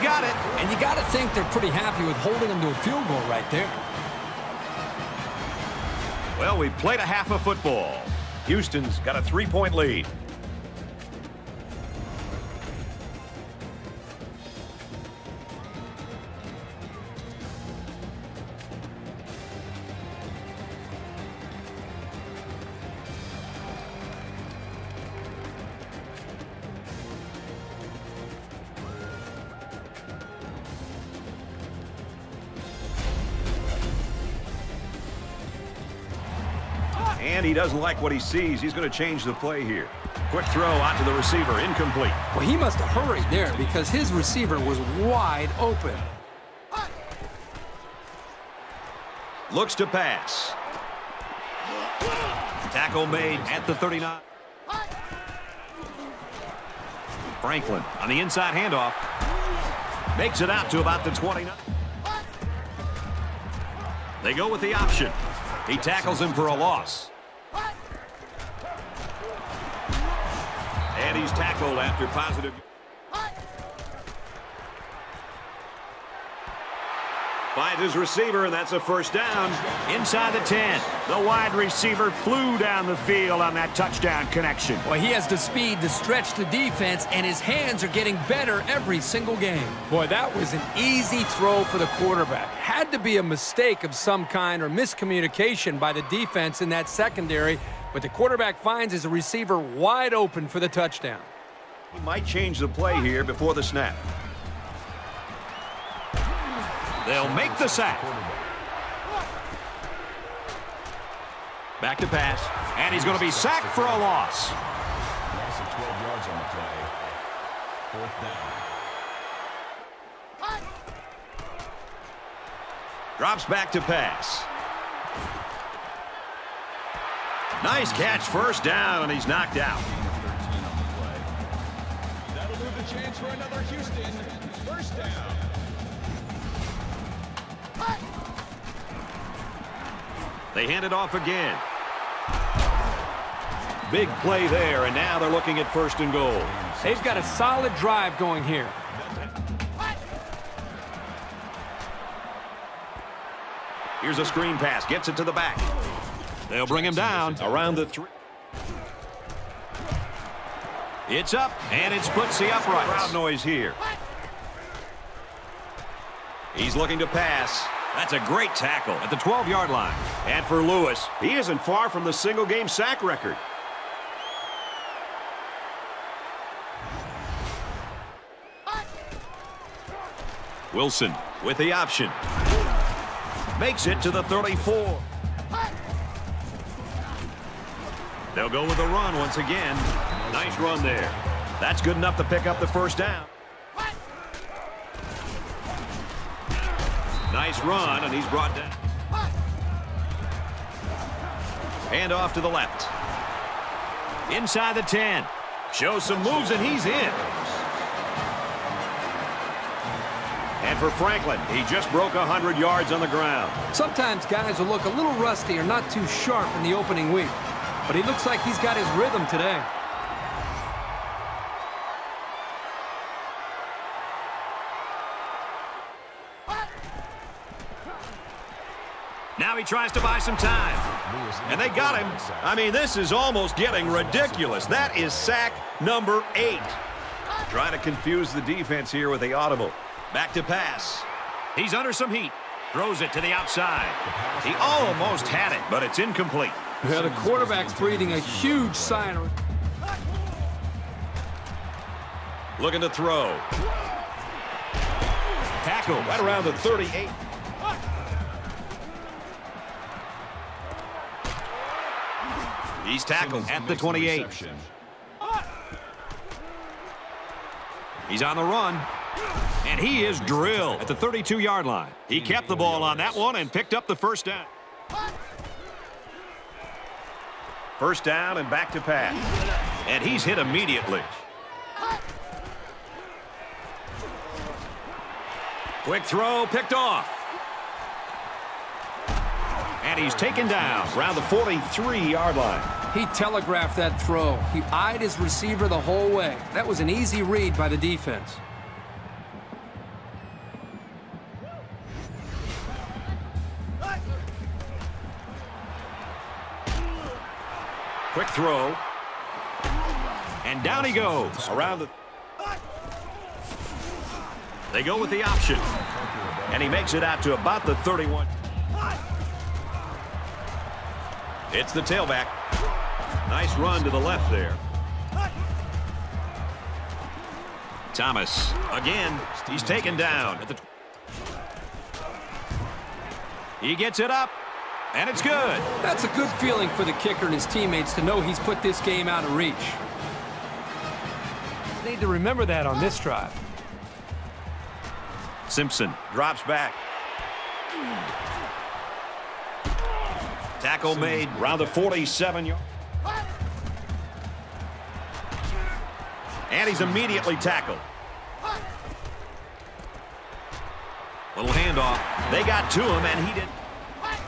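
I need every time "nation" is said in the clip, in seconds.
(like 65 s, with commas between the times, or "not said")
not said.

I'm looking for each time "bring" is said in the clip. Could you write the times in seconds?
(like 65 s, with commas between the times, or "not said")
156 s.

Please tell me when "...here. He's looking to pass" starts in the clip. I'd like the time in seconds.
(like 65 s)
163 s.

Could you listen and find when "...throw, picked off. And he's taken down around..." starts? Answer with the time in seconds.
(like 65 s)
286 s.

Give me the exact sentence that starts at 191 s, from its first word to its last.
That's good enough to pick up the first down.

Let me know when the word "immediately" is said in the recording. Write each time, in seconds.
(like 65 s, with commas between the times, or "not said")
280 s, 356 s.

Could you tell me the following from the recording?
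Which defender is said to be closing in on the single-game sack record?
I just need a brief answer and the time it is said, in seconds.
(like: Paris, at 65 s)
Lewis, at 170 s.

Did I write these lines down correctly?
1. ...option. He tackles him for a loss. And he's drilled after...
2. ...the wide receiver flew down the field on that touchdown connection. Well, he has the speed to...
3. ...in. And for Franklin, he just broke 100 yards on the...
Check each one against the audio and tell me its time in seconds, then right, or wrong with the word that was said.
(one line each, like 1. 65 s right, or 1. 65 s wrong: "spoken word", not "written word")
1. 64 s wrong: "tackled", not "drilled"
2. 81 s right
3. 206 s right.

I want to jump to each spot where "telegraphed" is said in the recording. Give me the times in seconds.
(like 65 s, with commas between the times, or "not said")
293 s.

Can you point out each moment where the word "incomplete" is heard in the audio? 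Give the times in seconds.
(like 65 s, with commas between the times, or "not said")
41 s, 245 s.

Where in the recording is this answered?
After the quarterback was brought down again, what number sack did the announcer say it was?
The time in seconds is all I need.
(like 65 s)
235 s.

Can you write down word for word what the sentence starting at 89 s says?
Boy, that was an easy throw for the quarterback.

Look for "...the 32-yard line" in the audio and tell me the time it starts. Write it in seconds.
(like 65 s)
270 s.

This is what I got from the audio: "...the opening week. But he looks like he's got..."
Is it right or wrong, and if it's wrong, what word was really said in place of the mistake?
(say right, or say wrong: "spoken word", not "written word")
right.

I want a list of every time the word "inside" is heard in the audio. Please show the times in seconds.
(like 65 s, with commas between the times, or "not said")
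58 s, 79 s, 204 s.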